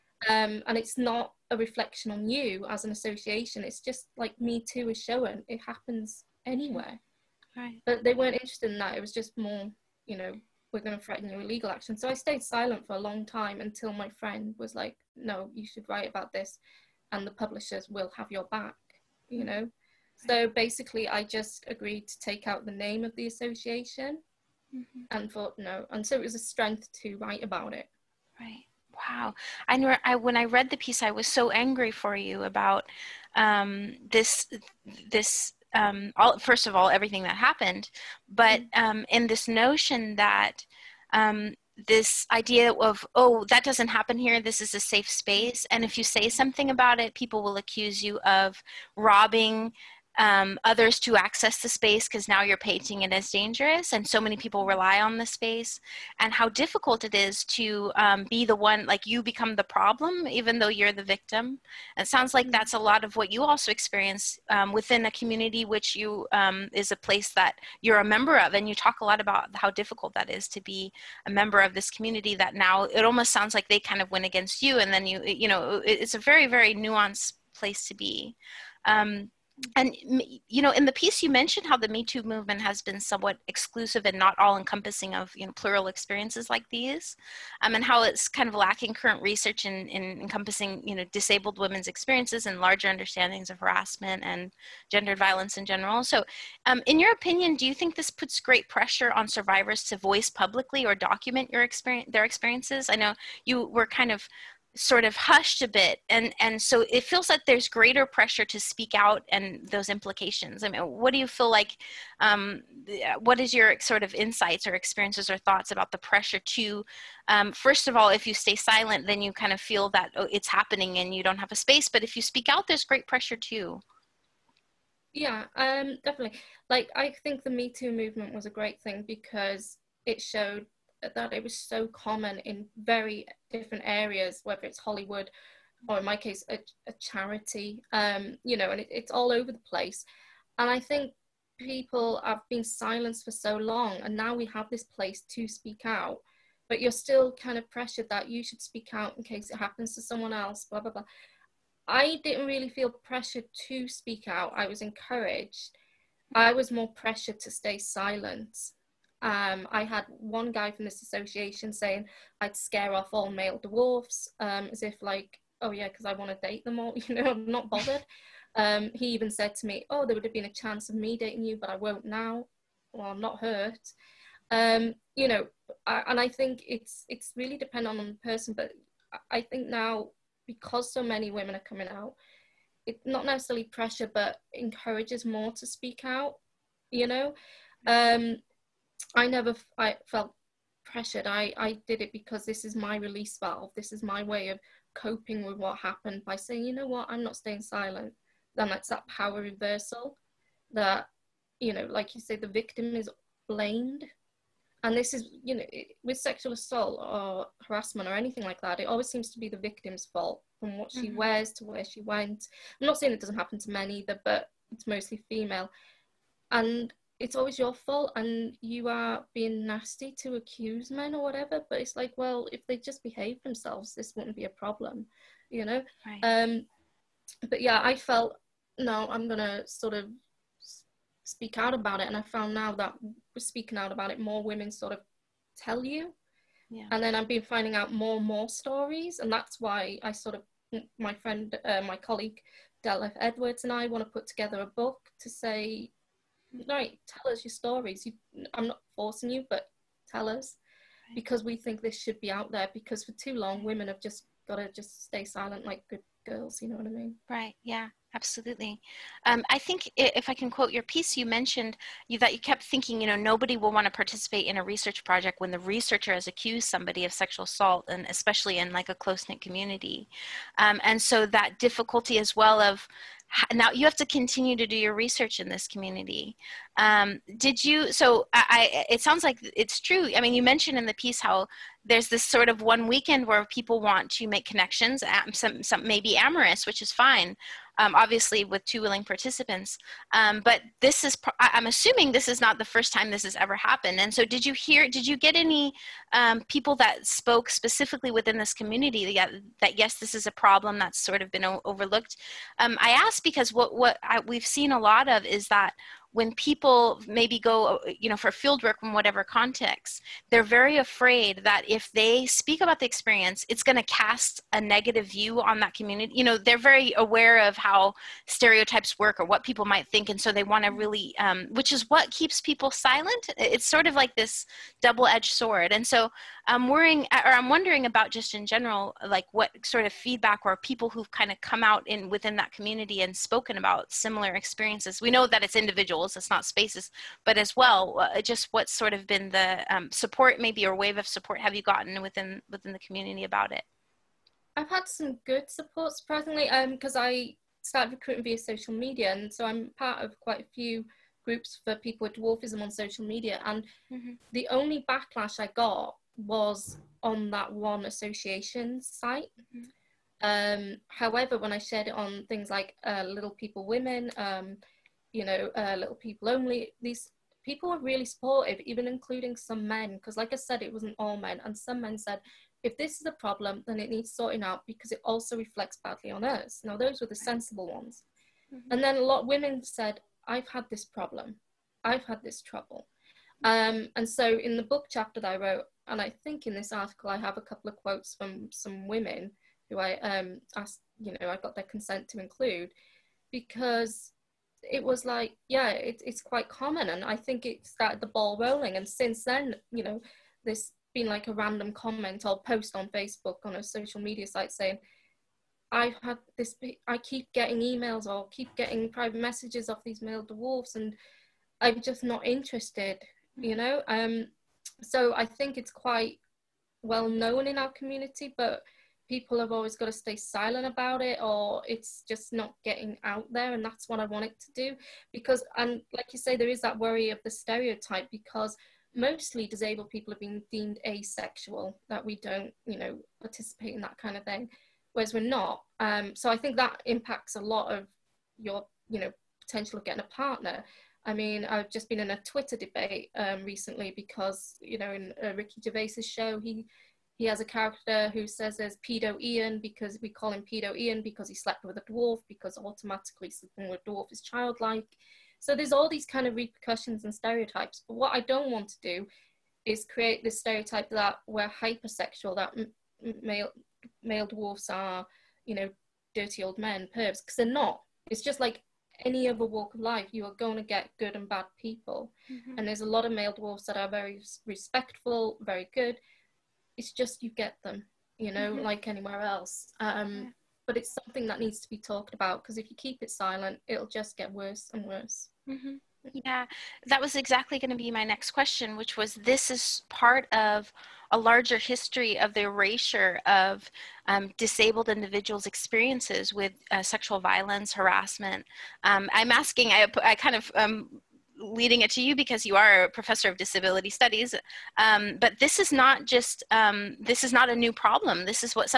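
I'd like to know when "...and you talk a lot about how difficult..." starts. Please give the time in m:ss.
1:08.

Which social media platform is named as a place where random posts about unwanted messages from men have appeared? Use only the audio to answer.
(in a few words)
Facebook.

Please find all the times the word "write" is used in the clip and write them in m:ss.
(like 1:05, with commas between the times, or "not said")
0:15, 0:27.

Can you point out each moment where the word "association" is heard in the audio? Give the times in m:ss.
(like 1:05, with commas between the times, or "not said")
0:02, 0:23, 2:41, 5:57.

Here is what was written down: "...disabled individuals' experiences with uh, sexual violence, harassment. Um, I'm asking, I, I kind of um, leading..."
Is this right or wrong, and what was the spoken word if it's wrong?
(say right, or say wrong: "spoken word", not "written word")
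right.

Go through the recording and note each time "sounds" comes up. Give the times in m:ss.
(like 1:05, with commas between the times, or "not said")
1:02, 1:13, 4:39.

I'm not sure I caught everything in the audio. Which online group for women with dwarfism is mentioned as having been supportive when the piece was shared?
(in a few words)
Little People Women.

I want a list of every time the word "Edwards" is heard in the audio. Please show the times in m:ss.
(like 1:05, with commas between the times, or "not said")
4:03.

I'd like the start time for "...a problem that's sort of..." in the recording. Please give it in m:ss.
5:00.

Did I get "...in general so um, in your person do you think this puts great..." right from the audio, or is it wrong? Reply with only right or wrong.
wrong.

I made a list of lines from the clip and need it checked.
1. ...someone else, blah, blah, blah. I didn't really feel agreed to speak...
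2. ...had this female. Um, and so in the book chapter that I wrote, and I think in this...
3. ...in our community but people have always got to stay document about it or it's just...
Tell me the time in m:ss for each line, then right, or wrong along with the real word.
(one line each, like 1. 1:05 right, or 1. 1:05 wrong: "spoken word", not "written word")
1. 2:30 wrong: "pressured", not "agreed"
2. 6:22 wrong: "trouble", not "female"
3. 6:57 wrong: "silent", not "document".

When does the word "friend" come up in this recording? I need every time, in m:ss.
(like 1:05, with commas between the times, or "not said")
0:14, 4:01.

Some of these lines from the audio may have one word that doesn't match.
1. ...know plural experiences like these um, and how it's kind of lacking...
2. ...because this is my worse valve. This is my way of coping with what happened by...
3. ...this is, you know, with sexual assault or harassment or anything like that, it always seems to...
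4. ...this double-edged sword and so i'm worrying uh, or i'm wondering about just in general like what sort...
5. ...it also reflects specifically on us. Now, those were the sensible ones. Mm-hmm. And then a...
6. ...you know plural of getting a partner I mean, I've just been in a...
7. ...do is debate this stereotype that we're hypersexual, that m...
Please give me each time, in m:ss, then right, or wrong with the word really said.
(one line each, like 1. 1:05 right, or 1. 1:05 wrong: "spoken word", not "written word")
1. 1:25 right
2. 3:12 wrong: "release", not "worse"
3. 3:24 right
4. 5:24 right
5. 6:14 wrong: "badly", not "specifically"
6. 7:18 wrong: "potential", not "plural"
7. 7:38 wrong: "create", not "debate".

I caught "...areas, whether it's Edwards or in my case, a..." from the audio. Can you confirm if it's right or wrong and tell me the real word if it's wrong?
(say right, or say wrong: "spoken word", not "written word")
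wrong: "Hollywood", not "Edwards".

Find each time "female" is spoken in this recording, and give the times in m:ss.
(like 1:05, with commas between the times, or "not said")
3:35.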